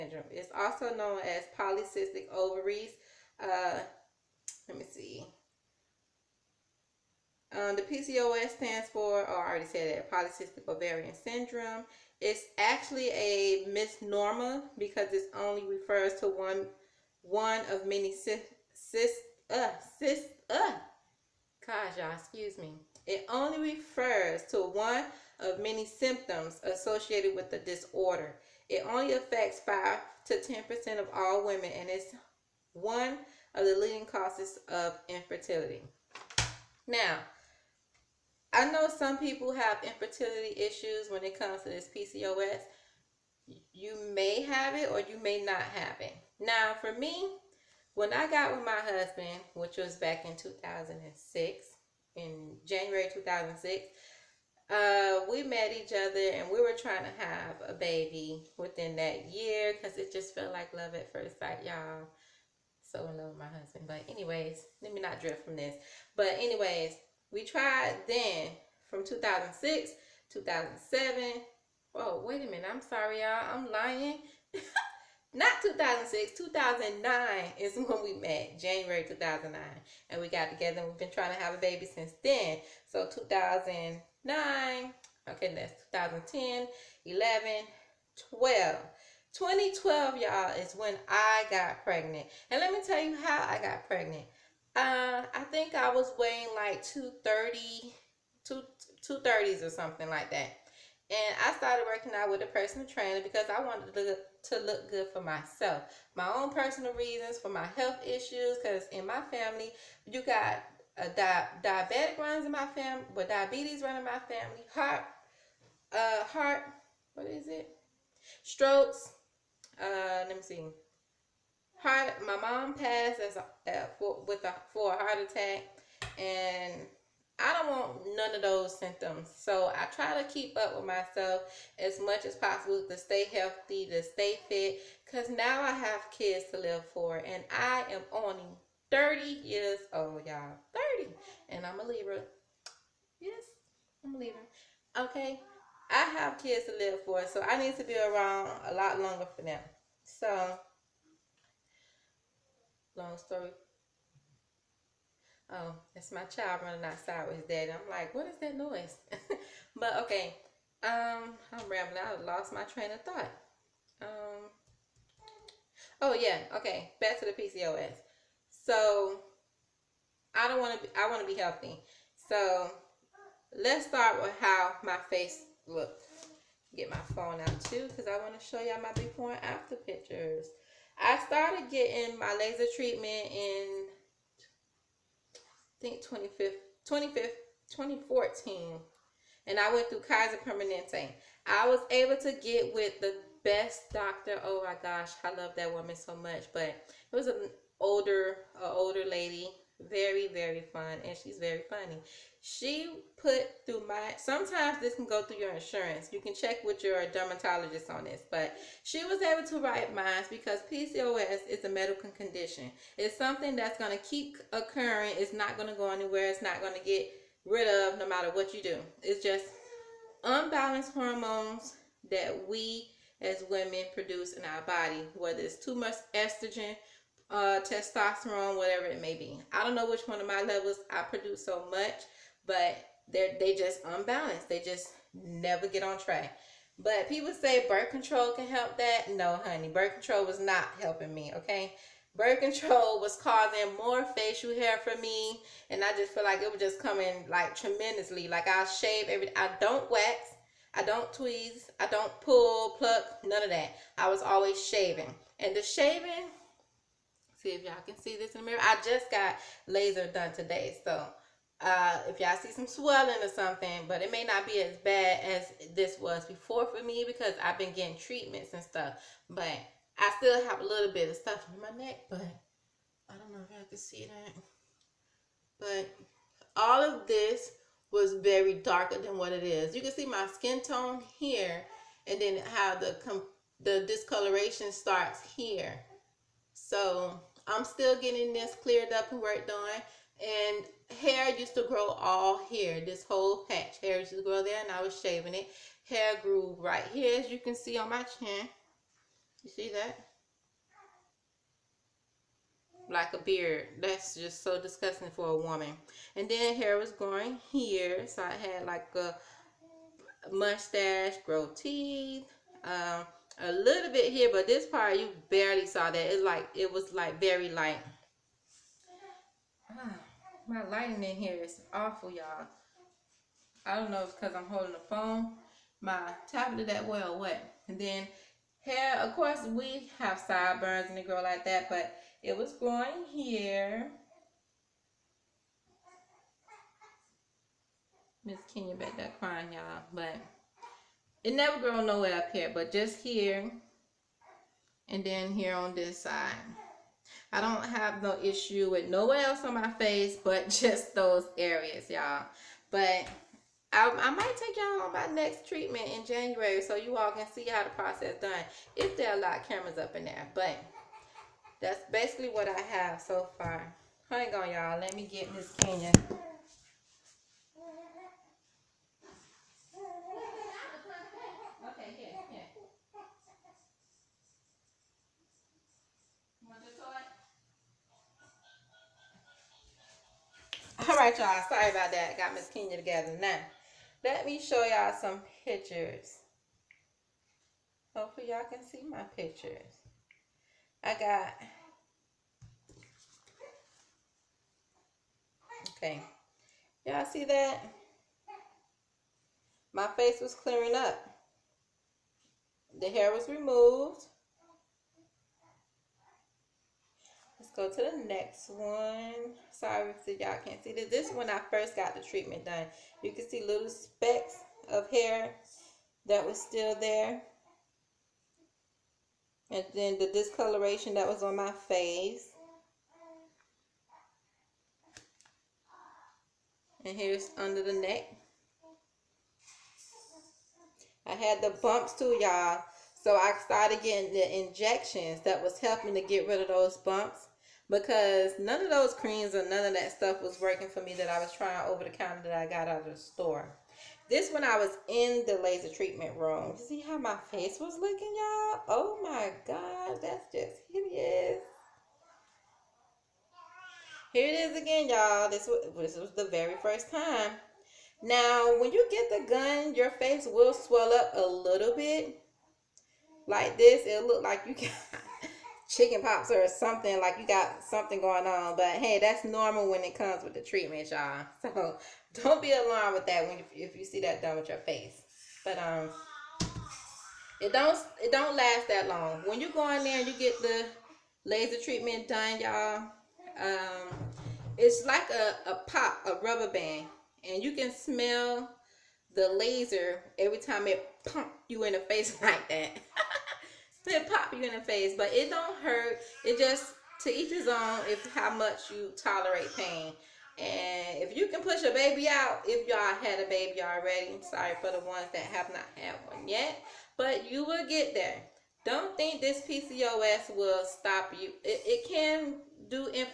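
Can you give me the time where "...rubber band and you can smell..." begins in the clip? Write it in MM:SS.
08:06.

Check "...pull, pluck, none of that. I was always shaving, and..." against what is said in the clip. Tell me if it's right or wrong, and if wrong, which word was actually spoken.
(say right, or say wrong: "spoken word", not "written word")
right.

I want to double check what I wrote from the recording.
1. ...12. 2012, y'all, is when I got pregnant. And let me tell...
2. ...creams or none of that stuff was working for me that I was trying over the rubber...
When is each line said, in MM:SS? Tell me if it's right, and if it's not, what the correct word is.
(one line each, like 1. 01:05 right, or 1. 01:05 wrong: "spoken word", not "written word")
1. 01:28 right
2. 07:18 wrong: "counter", not "rubber".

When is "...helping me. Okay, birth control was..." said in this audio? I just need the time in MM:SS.
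04:00.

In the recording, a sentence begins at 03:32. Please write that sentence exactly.
It's something that's gonna keep occurring, it's not gonna go anywhere, it's not gonna get rid of no matter what you do.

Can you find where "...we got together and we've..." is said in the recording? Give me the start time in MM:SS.
01:20.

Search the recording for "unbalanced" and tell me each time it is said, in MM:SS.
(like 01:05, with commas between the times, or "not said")
03:40, 03:53.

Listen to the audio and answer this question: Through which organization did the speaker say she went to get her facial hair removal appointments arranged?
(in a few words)
Kaiser Permanente.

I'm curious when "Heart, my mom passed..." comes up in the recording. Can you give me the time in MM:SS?
02:01.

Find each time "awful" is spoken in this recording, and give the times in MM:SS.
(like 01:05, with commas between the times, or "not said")
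05:21.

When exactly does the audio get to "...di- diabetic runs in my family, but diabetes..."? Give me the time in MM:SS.
01:51.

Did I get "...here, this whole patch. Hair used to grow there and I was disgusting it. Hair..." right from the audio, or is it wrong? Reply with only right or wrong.
wrong.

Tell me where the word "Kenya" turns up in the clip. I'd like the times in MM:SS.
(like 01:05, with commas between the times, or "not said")
05:38, 06:05, 06:22.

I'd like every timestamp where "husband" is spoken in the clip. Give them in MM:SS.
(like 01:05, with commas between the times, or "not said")
00:48, 01:03.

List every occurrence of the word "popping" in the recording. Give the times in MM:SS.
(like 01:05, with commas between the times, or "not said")
not said.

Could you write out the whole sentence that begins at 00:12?
It's actually a misnomer because it only refers to one one of many cysts.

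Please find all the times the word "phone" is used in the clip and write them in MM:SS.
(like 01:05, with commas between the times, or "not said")
02:57, 05:24.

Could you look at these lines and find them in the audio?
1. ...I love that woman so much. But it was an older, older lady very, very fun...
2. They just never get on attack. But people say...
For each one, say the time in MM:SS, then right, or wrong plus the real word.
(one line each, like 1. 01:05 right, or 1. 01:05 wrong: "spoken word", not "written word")
1. 03:15 right
2. 03:54 wrong: "track", not "attack".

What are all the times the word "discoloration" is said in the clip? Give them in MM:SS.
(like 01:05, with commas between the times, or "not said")
04:43, 07:00.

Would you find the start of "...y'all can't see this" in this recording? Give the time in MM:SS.
06:50.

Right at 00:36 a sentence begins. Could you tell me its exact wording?
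Now, I know some people have infertility issues when it comes to this PCOS.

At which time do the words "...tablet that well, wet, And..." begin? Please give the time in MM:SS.
05:26.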